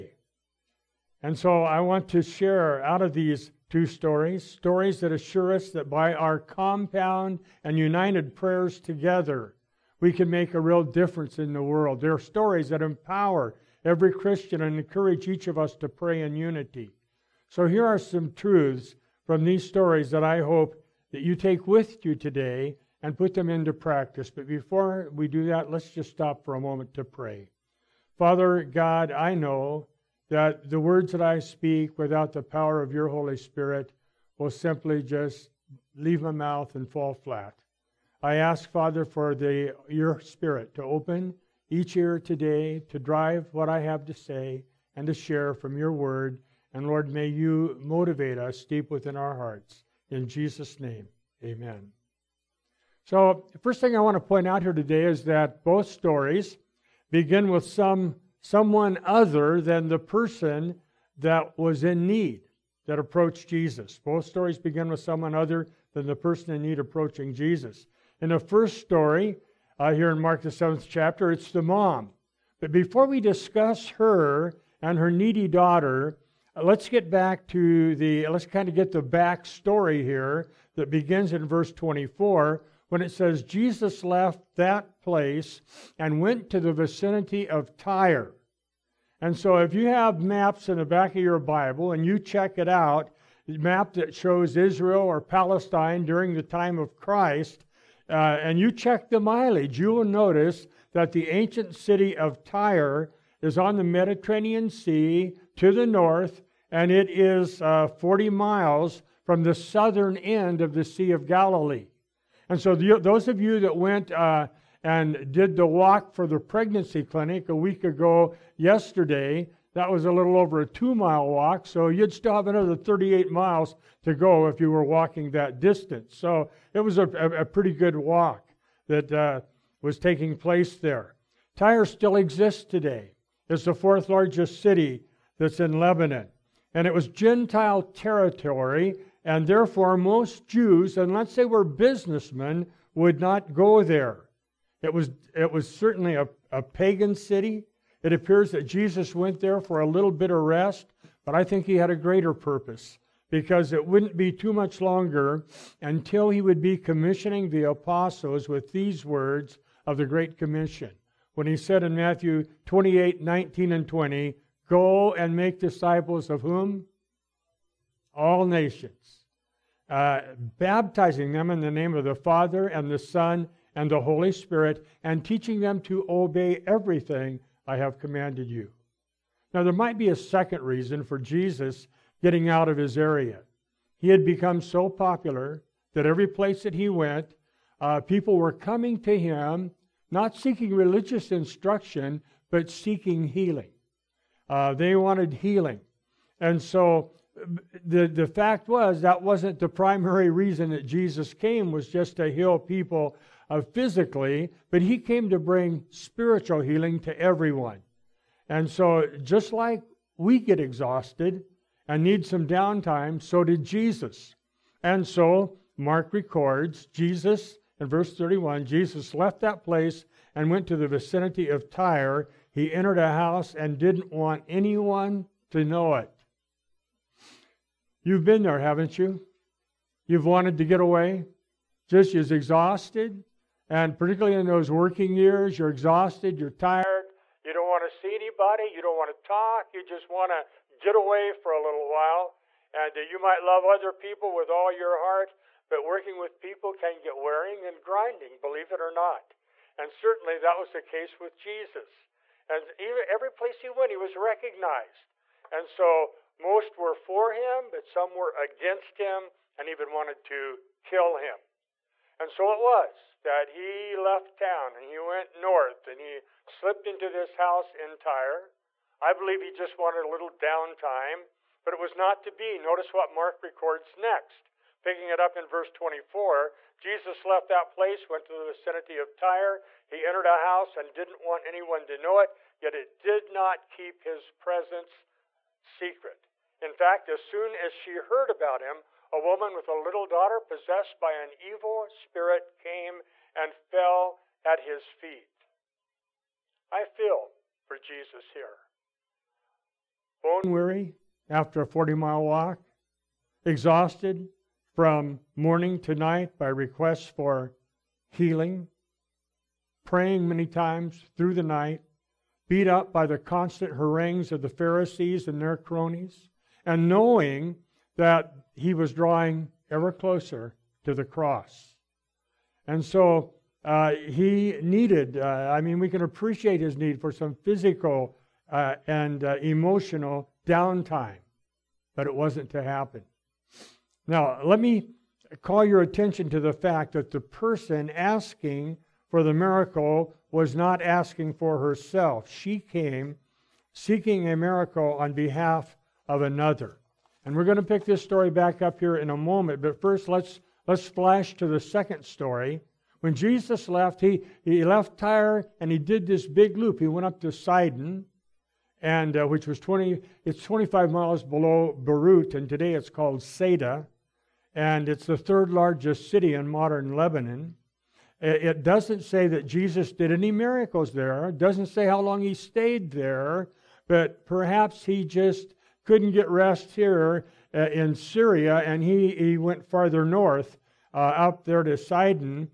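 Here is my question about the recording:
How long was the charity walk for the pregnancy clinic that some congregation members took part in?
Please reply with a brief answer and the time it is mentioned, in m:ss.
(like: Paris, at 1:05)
a little over 2 miles, at 2:00.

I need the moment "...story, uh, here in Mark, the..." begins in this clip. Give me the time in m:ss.
1:08.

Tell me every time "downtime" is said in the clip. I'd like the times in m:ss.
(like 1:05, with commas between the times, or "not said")
3:32, 4:30, 5:30.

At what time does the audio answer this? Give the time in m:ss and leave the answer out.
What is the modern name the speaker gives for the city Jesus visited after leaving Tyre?
6:03.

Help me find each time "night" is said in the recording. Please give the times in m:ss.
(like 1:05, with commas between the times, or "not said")
5:05, 5:11.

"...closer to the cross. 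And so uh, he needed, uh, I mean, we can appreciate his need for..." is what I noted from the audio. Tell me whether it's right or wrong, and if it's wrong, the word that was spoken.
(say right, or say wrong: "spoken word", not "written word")
right.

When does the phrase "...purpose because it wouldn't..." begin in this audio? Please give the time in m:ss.
2:32.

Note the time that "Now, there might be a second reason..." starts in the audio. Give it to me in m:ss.
2:59.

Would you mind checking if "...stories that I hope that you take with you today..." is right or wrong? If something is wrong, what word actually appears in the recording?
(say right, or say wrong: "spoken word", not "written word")
right.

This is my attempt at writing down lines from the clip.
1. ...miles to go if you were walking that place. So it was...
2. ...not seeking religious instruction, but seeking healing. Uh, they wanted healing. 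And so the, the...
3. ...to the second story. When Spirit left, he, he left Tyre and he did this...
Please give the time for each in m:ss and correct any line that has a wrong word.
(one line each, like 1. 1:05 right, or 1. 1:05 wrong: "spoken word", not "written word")
1. 2:03 wrong: "distance", not "place"
2. 3:10 right
3. 5:51 wrong: "Jesus", not "Spirit".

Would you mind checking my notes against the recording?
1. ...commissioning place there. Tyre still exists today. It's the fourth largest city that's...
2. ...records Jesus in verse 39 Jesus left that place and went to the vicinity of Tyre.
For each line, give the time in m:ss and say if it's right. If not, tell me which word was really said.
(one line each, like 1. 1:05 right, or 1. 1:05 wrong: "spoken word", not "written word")
1. 2:09 wrong: "taking", not "commissioning"
2. 3:36 wrong: "31", not "39".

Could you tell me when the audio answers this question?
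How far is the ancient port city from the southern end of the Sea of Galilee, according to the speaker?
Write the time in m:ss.
1:47.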